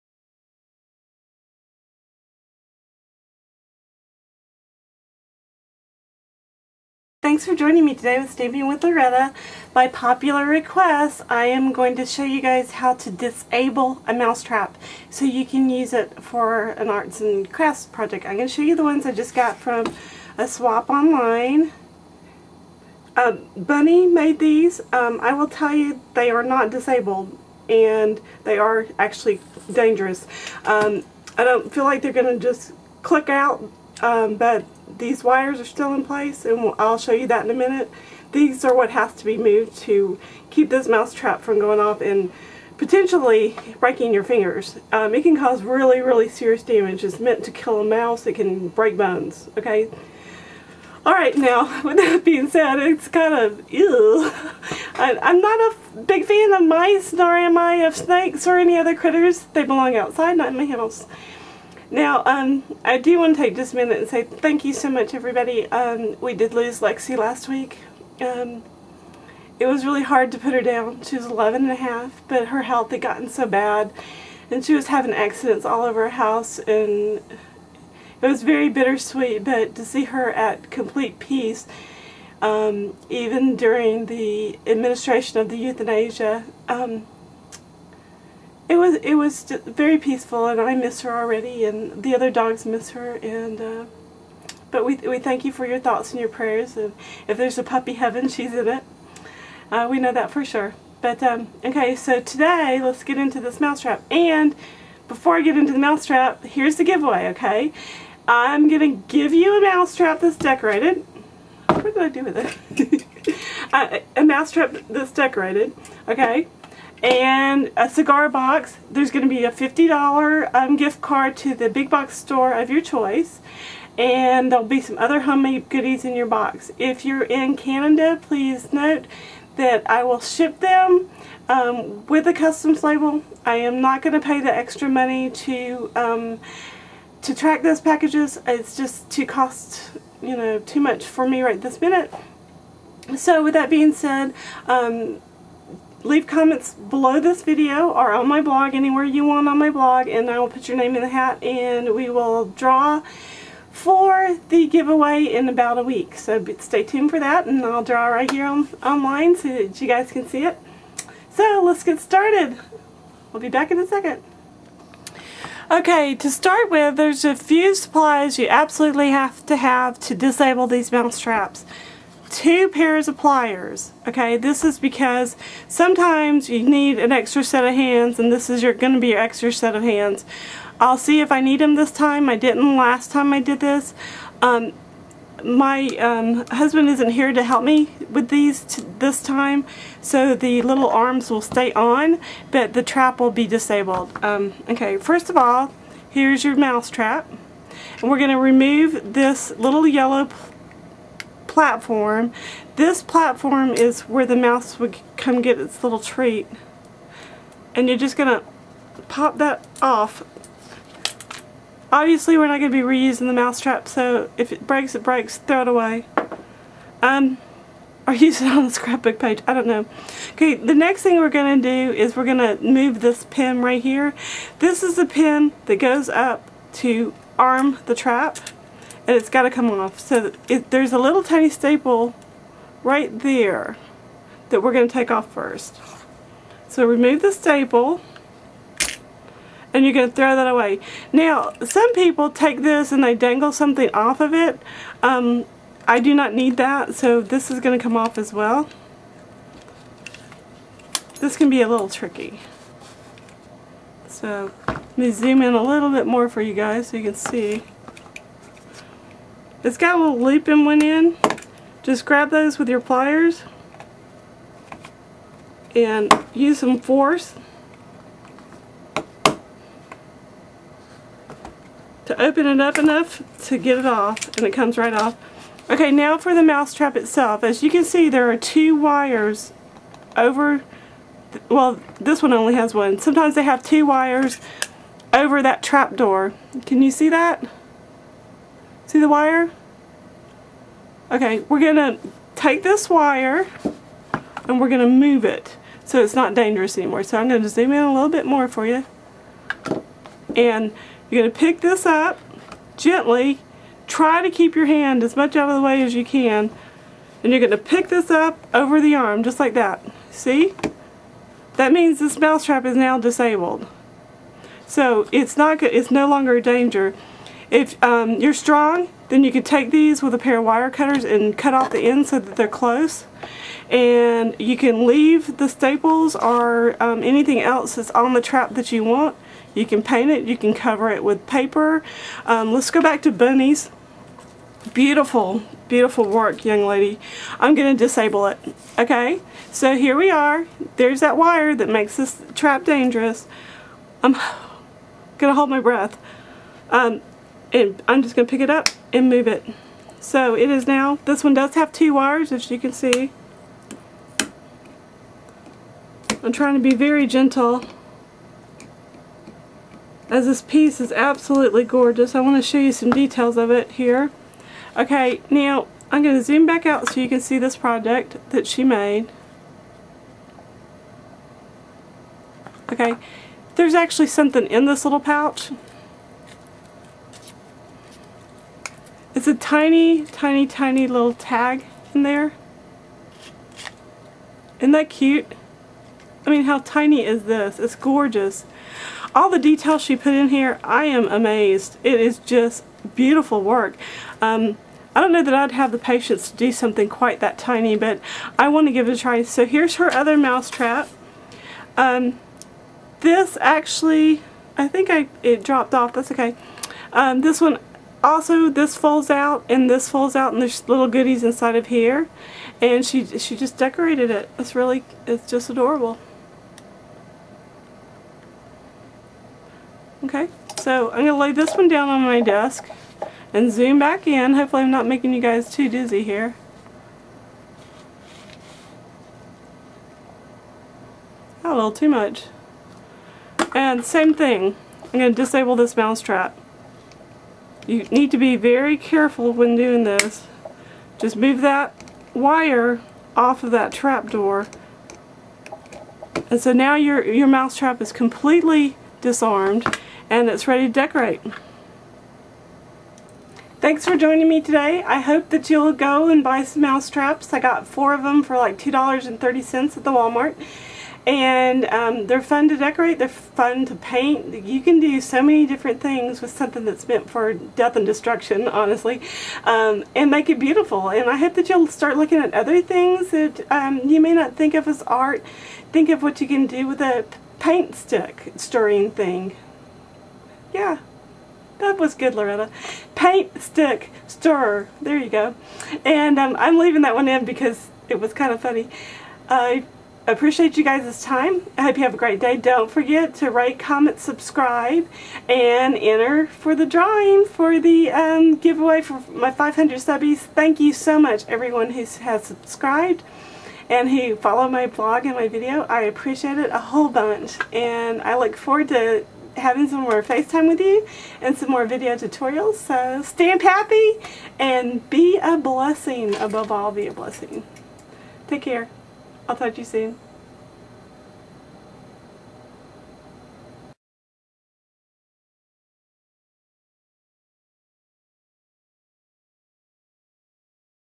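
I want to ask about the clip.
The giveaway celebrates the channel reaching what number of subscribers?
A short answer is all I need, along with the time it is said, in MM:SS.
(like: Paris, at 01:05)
500, at 08:19.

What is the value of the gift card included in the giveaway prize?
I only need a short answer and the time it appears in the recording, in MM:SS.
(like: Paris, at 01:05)
$50, at 01:59.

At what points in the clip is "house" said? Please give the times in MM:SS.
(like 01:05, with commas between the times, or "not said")
01:00, 01:16.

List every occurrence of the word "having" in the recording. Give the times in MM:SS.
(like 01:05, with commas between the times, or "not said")
01:14, 08:29.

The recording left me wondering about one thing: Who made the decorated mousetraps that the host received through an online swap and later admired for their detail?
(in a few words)
Bunny.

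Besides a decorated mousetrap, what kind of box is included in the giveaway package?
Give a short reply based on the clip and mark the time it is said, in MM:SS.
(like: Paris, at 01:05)
A cigar box, at 01:57.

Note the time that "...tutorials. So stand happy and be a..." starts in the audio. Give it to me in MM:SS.
08:31.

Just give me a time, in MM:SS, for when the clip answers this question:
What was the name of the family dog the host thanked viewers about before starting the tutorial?
01:06.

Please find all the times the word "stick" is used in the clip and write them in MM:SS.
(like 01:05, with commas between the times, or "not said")
07:57, 08:03.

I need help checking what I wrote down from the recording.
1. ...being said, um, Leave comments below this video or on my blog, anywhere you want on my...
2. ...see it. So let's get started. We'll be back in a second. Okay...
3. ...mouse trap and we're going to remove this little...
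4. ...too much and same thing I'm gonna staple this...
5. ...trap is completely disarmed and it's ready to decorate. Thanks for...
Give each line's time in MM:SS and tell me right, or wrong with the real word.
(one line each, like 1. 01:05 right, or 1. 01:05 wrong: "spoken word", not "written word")
1. 02:23 right
2. 02:40 right
3. 03:16 right
4. 07:11 wrong: "disable", not "staple"
5. 07:27 right.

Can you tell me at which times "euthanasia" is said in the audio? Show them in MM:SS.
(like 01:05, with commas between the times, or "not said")
01:25.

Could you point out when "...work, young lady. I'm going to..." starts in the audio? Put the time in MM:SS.
05:36.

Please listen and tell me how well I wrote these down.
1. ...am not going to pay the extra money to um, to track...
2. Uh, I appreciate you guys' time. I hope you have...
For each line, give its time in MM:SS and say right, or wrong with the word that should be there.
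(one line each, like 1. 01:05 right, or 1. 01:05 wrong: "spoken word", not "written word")
1. 02:13 right
2. 08:09 right.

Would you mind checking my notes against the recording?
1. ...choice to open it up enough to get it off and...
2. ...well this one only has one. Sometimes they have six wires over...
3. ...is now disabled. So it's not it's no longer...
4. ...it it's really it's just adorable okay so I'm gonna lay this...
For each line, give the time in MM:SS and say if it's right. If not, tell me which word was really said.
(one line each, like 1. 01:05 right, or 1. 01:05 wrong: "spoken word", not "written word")
1. 04:26 wrong: "force", not "choice"
2. 04:41 wrong: "two", not "six"
3. 05:12 right
4. 06:54 right.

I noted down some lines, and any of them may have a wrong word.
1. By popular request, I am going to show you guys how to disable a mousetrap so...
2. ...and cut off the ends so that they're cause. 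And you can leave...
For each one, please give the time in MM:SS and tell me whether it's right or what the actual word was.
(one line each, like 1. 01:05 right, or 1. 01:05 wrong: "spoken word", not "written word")
1. 00:09 right
2. 05:21 wrong: "close", not "cause".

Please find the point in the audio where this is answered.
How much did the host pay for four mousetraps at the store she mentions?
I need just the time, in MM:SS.
07:38.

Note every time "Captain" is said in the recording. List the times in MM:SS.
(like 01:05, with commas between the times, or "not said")
not said.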